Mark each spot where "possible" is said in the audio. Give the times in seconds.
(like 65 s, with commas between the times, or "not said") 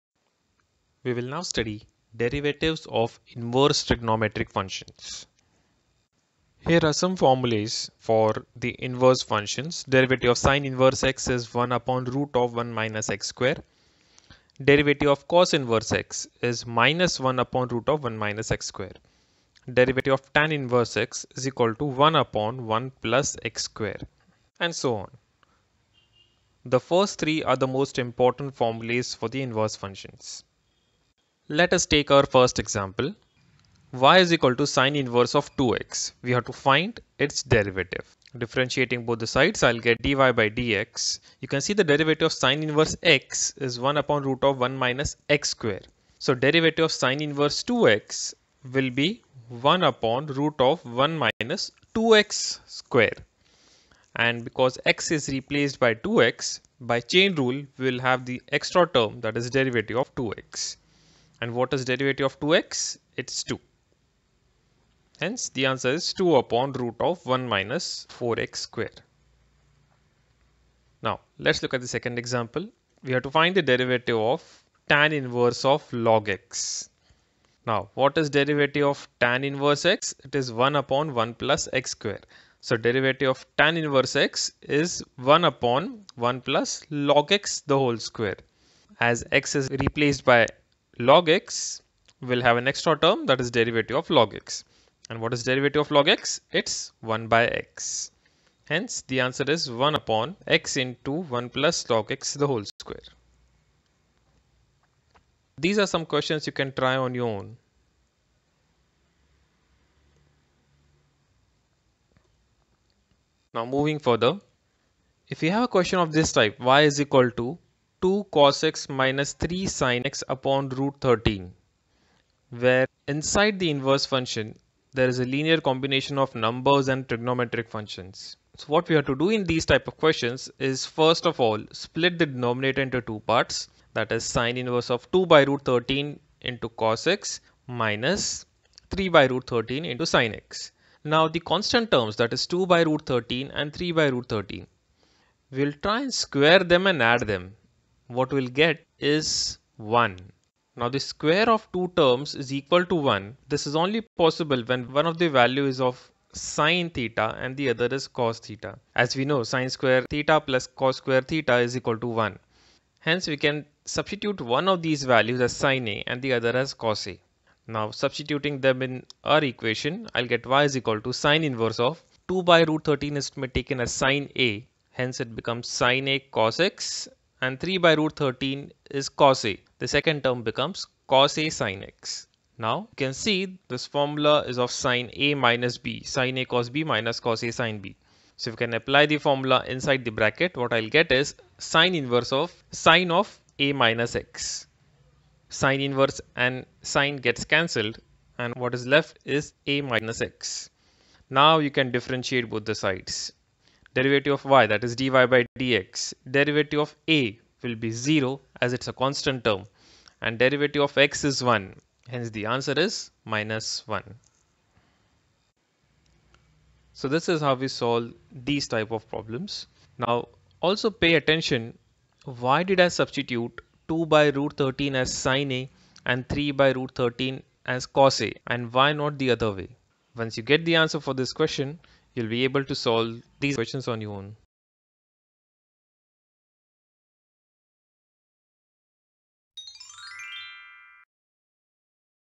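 154 s.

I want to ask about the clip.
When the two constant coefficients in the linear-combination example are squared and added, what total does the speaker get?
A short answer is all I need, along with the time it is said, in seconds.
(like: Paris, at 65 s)
1, at 148 s.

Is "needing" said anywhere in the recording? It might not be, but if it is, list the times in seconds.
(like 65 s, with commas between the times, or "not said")
not said.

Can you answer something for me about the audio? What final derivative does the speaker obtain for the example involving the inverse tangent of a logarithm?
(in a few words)
1/(x(1+(log x)^2)).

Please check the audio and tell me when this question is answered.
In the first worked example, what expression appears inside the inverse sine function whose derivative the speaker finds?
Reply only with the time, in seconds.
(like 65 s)
34 s.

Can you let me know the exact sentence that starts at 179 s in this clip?
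The second term becomes cos A sin X.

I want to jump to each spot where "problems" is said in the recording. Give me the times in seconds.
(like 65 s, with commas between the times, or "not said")
219 s.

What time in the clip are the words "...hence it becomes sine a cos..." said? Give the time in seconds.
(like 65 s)
174 s.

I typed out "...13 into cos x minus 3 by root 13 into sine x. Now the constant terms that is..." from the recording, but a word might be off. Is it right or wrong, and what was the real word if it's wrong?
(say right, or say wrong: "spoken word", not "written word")
right.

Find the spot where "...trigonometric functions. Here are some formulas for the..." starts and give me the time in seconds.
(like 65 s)
3 s.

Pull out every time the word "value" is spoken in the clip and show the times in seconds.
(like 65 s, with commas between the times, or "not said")
155 s, 165 s.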